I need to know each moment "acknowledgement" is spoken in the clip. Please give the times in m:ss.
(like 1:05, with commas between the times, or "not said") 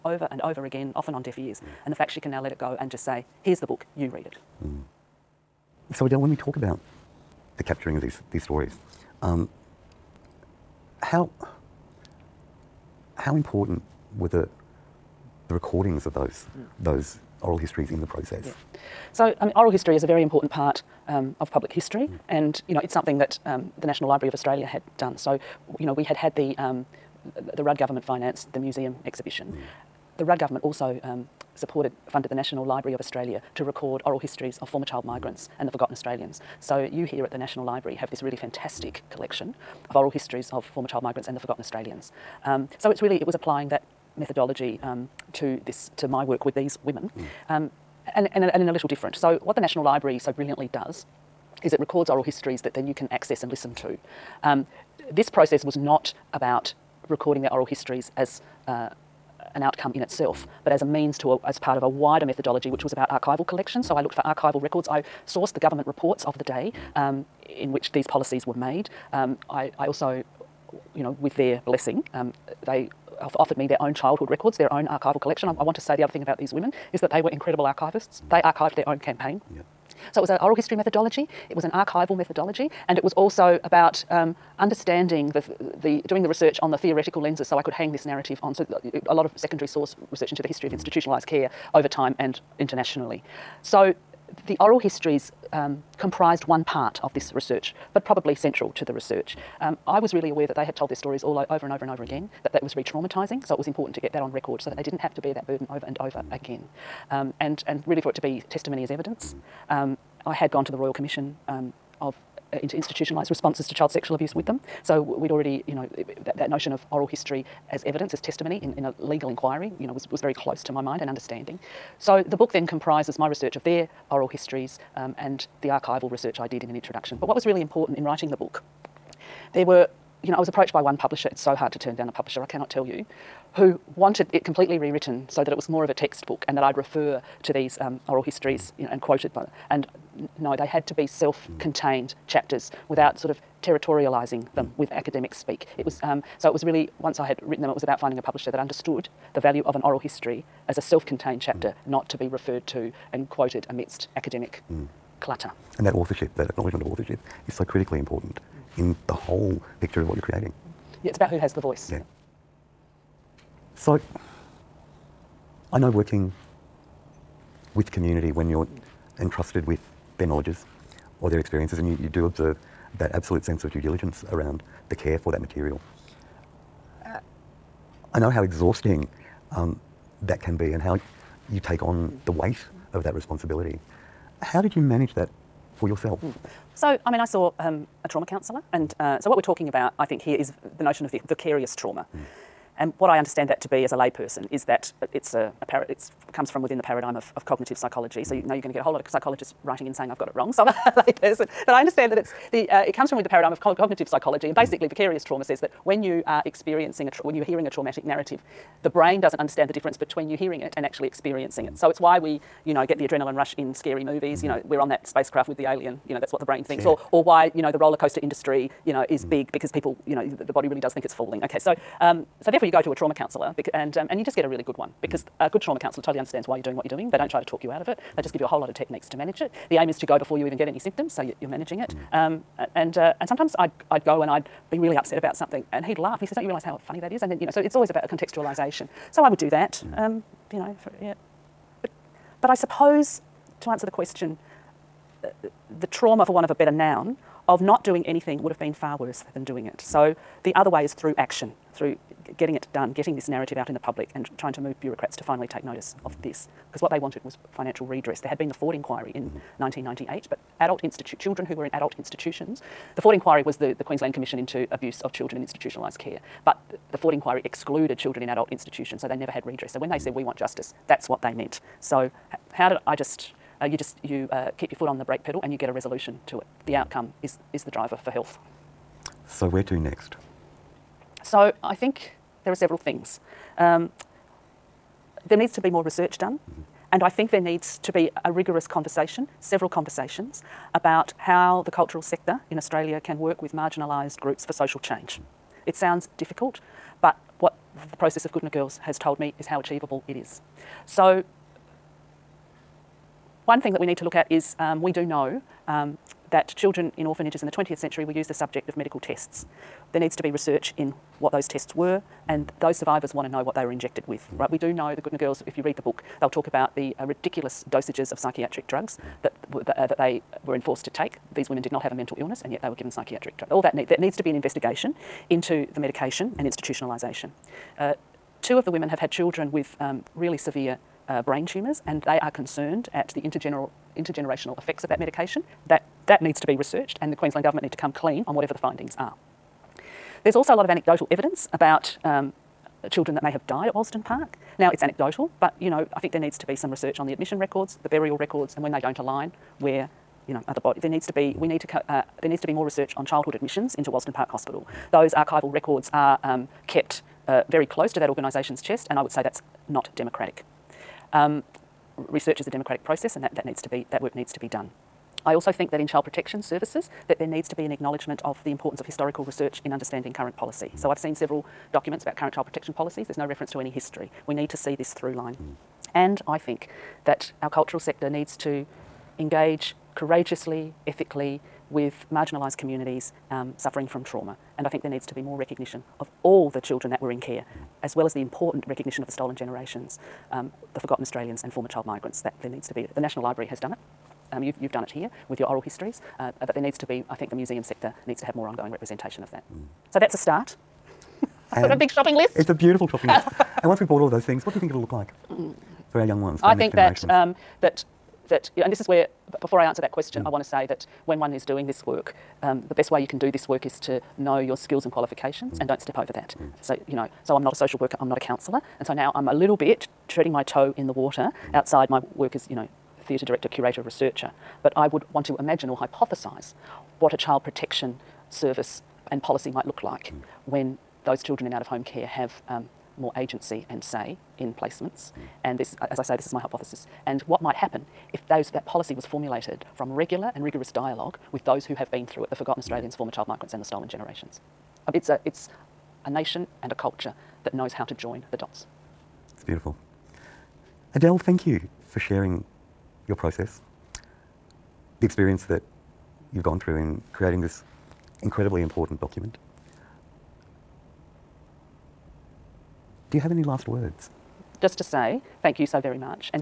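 2:36, 6:07.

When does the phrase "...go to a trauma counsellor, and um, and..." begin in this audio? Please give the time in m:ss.
3:42.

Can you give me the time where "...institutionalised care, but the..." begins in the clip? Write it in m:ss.
4:25.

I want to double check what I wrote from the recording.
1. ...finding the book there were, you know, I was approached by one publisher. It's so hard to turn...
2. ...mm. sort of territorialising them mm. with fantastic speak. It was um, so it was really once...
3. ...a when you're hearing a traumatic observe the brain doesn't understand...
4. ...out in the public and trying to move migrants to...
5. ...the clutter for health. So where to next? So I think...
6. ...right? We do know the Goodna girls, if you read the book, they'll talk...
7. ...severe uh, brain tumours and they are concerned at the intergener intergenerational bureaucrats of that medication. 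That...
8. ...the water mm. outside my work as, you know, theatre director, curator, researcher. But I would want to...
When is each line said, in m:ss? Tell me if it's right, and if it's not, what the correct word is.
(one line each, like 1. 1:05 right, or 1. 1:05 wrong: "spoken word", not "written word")
1. 2:08 wrong: "writing", not "finding"
2. 2:23 wrong: "academic", not "fantastic"
3. 3:27 wrong: "narrative", not "observe"
4. 4:13 wrong: "bureaucrats", not "migrants"
5. 4:37 wrong: "driver", not "clutter"
6. 5:14 right
7. 5:30 wrong: "effects", not "bureaucrats"
8. 7:00 right.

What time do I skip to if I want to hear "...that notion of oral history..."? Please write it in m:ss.
1:56.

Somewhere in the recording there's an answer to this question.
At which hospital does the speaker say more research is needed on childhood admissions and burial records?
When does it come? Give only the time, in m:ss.
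5:53.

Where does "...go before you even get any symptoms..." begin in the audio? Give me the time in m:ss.
3:50.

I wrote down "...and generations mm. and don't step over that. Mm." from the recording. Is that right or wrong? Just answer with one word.
wrong.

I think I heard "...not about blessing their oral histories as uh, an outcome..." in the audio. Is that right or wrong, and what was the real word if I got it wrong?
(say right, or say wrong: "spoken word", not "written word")
wrong: "recording", not "blessing".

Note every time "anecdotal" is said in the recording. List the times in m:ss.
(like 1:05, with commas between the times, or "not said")
5:40, 5:44.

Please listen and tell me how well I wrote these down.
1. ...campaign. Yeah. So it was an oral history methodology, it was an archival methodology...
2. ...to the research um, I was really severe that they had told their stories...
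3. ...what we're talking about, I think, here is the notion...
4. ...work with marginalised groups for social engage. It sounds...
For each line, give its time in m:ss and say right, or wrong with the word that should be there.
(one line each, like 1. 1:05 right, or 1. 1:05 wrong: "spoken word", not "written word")
1. 1:18 right
2. 1:38 wrong: "aware", not "severe"
3. 3:09 right
4. 4:53 wrong: "change", not "engage".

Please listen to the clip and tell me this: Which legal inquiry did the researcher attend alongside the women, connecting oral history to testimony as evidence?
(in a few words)
Royal Commission.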